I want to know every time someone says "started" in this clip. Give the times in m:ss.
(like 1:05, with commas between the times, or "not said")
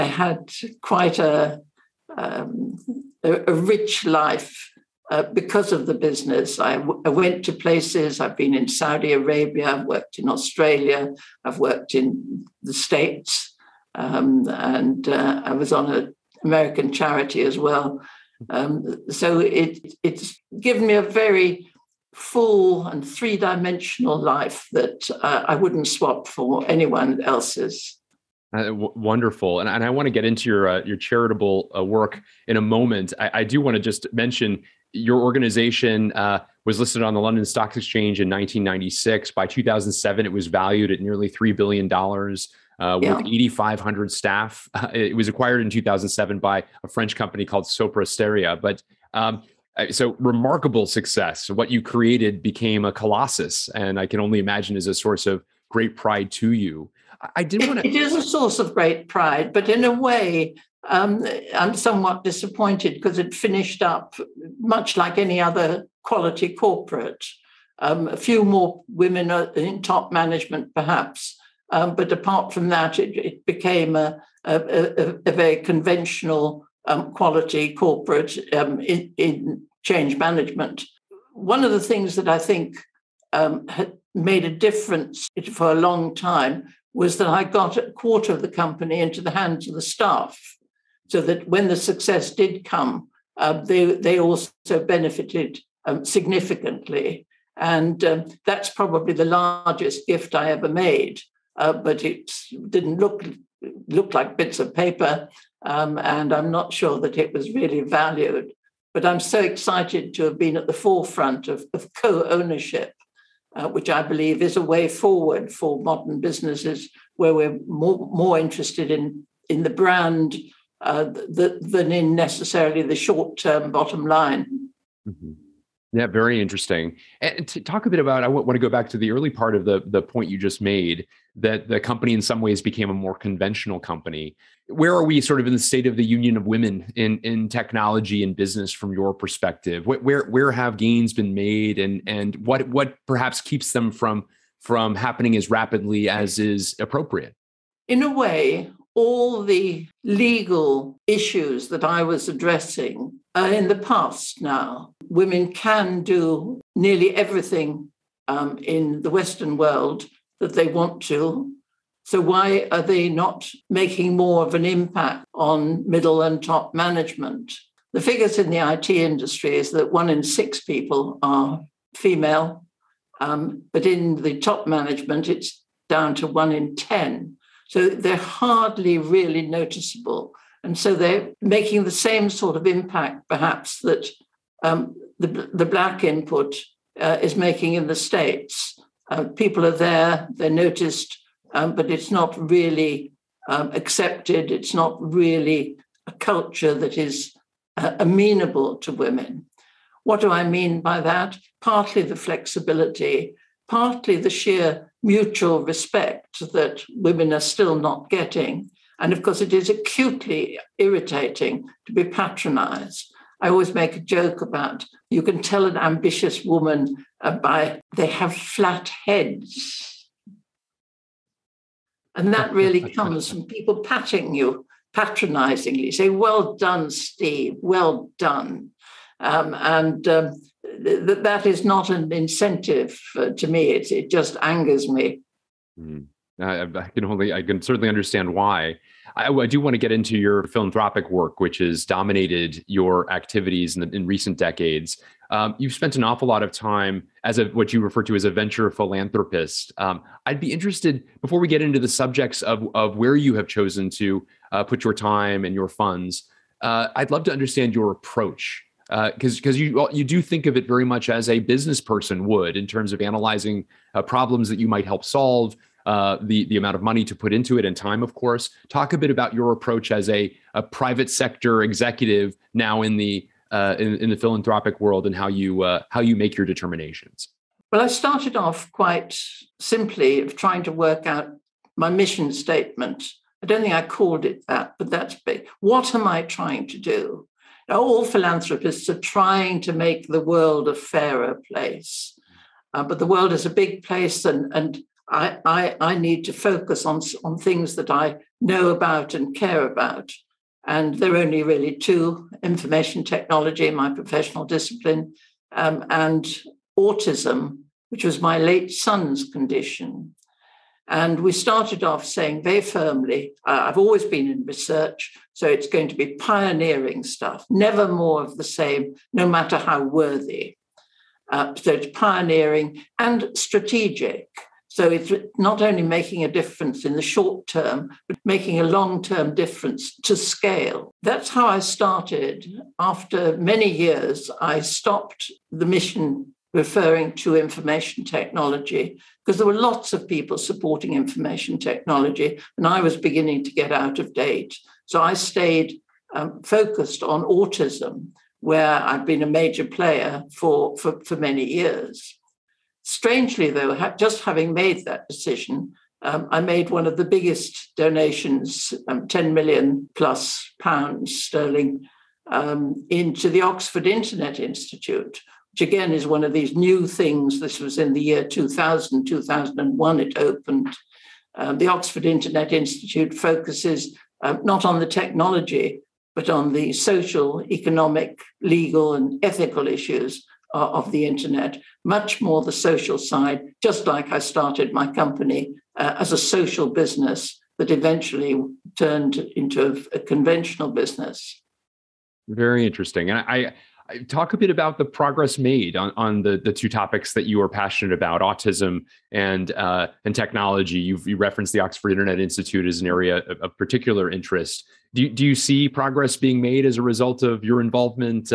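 4:37, 5:11, 5:31, 6:24.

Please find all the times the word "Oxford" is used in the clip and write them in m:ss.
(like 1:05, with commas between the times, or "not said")
6:03, 6:11, 6:41.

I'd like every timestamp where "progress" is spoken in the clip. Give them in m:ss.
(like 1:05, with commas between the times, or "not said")
6:34, 6:45.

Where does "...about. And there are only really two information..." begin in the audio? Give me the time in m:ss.
4:59.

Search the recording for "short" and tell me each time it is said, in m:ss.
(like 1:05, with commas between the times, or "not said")
2:02, 5:27.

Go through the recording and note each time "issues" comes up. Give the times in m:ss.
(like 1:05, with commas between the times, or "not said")
2:31, 6:19.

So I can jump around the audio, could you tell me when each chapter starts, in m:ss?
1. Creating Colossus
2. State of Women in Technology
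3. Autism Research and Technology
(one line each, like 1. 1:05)
1. 0:28
2. 2:07
3. 6:32.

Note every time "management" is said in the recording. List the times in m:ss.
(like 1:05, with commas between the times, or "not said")
1:10, 1:20, 2:46, 2:54.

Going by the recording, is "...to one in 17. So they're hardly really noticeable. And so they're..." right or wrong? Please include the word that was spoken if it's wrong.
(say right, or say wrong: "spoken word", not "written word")
wrong: "10", not "17".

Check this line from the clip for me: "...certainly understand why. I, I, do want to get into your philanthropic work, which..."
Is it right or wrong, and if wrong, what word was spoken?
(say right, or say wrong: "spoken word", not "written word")
right.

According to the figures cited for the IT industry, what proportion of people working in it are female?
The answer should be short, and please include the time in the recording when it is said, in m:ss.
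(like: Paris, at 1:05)
one in six, at 2:49.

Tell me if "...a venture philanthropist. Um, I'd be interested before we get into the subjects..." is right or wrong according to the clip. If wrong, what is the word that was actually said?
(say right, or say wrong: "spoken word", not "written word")
right.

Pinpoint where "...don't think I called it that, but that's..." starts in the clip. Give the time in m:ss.
4:43.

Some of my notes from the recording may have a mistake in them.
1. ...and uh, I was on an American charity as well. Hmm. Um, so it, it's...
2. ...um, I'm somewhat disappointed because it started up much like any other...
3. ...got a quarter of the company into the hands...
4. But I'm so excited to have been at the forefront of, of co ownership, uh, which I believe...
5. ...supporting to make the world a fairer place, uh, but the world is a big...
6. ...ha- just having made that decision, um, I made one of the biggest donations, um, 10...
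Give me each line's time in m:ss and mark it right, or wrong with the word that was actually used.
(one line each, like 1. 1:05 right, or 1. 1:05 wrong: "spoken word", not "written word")
1. 0:14 right
2. 1:00 wrong: "finished", not "started"
3. 1:27 right
4. 1:48 right
5. 4:49 wrong: "trying", not "supporting"
6. 5:53 right.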